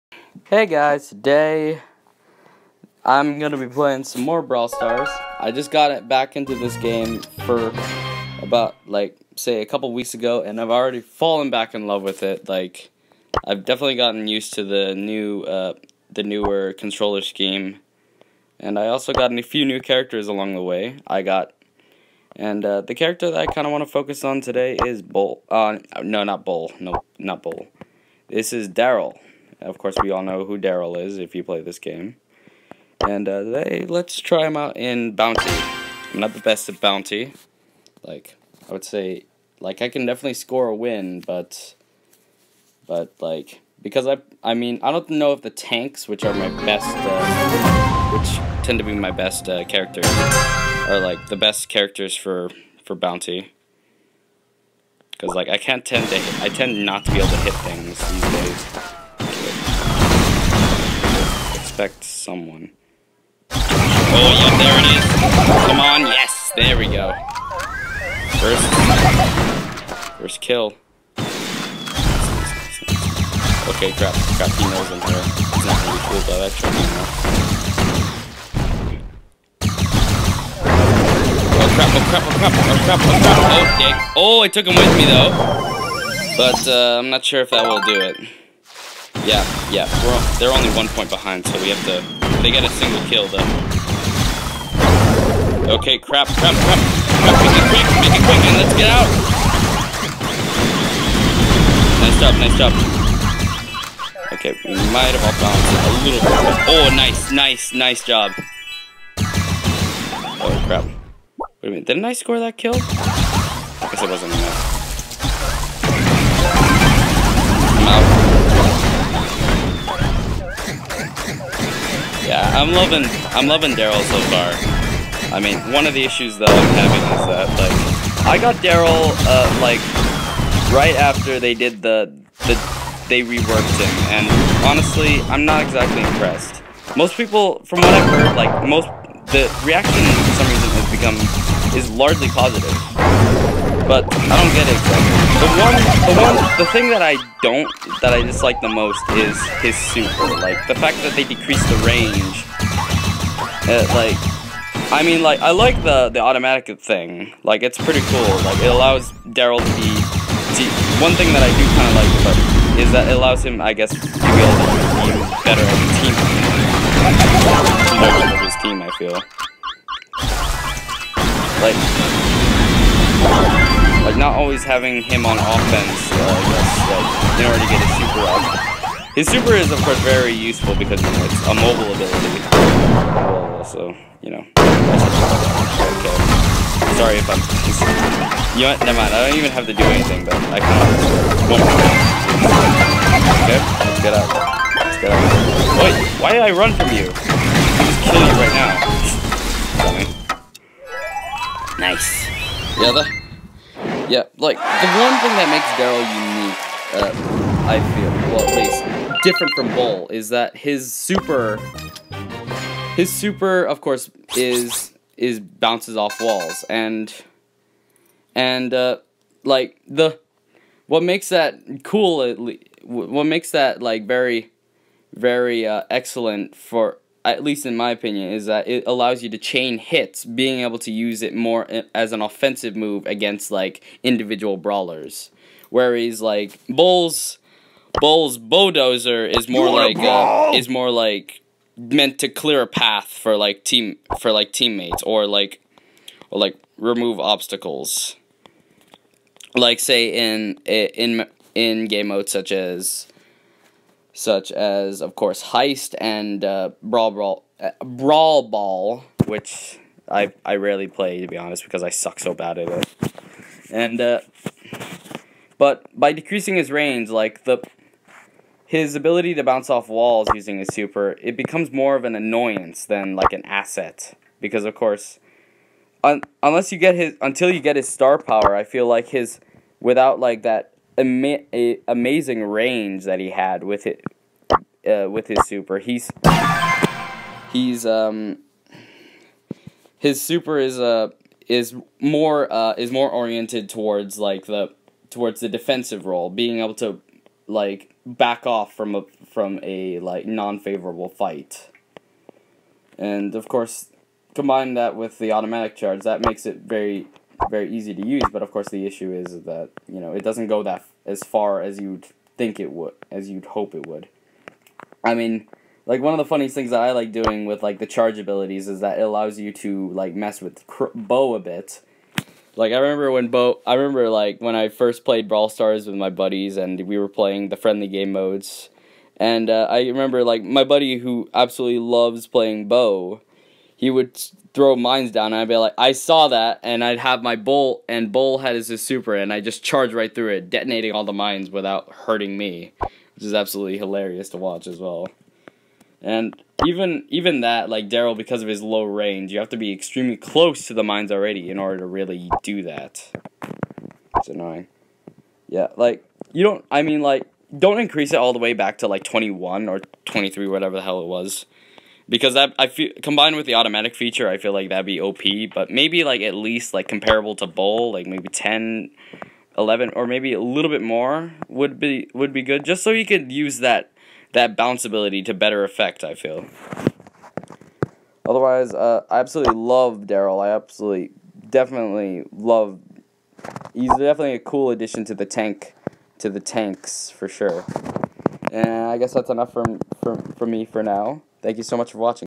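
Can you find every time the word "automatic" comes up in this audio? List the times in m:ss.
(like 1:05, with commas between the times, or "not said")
2:36, 5:05, 6:03.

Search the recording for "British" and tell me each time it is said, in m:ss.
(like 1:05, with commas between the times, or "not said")
not said.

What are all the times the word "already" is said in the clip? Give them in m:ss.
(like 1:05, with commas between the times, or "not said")
0:10, 5:51.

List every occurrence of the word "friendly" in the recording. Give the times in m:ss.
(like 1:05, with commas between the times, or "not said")
5:27.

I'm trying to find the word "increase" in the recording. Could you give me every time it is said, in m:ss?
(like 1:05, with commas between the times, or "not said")
5:57.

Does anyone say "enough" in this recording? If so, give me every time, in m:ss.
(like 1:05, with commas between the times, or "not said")
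1:54, 6:29.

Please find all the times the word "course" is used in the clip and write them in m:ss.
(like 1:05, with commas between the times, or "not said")
0:29, 2:59, 3:33, 4:15, 4:34, 5:03, 5:08.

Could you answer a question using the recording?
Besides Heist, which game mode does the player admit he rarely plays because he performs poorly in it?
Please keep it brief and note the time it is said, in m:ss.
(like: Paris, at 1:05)
Brawl Ball, at 4:17.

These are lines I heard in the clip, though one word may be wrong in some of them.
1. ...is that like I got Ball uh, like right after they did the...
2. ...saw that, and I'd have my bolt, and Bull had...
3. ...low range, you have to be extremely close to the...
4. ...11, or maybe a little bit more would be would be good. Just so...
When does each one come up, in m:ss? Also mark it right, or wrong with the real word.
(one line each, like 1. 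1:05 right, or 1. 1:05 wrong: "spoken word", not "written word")
1. 2:07 wrong: "Darryl", not "Ball"
2. 5:35 right
3. 5:48 right
4. 6:09 right.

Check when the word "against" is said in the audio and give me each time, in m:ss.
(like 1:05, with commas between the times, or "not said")
3:53.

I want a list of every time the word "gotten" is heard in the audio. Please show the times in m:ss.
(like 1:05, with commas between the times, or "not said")
0:13.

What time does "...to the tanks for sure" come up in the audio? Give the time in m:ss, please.
6:26.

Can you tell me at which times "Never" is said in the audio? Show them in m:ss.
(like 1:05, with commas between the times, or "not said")
3:08.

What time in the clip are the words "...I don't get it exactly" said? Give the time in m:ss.
2:24.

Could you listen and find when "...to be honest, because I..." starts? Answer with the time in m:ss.
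4:21.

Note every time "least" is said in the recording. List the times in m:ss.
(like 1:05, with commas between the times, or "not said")
3:28, 3:47, 6:06.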